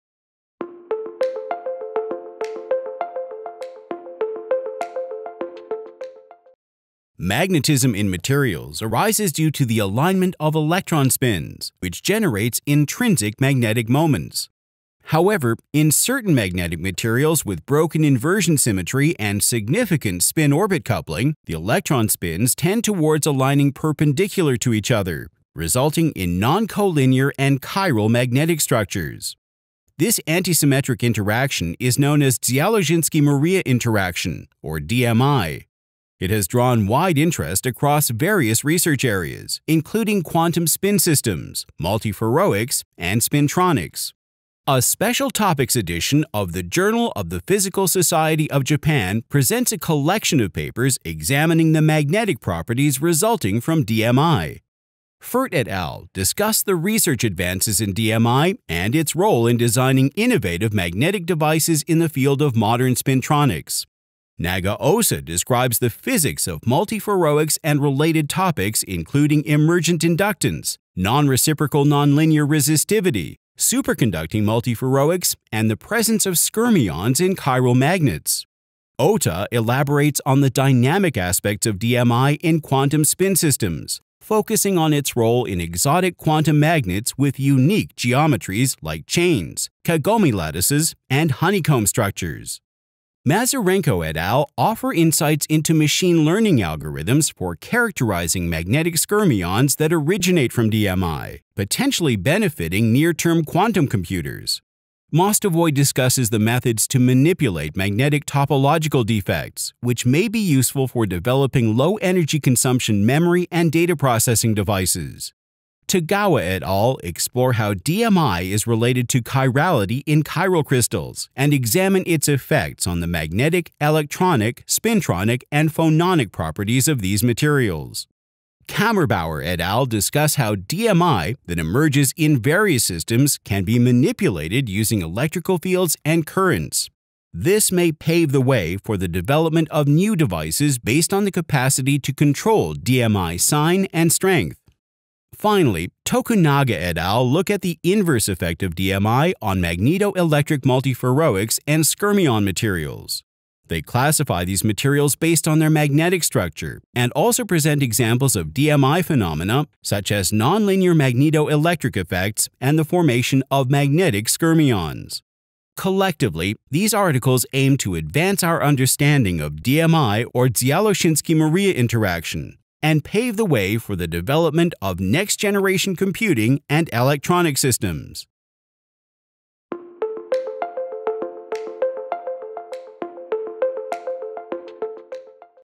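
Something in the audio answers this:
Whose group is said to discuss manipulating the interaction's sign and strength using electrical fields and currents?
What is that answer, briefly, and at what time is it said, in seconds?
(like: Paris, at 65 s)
Kammerbauer, at 128 s.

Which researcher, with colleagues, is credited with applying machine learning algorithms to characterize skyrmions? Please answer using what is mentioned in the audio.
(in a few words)
Mazurenko.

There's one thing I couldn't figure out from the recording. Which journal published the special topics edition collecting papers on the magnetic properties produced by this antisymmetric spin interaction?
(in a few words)
Journal of the Physical Society of Japan.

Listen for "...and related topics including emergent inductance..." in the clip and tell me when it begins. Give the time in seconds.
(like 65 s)
67 s.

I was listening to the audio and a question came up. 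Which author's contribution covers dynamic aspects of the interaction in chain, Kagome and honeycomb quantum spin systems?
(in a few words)
OTA.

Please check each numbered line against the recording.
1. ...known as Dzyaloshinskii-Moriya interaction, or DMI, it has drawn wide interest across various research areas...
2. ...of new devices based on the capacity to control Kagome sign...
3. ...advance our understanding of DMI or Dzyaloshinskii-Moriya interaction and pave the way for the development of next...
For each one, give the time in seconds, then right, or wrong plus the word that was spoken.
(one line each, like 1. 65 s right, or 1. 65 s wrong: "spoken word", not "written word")
1. 31 s right
2. 139 s wrong: "DMI", not "Kagome"
3. 167 s right.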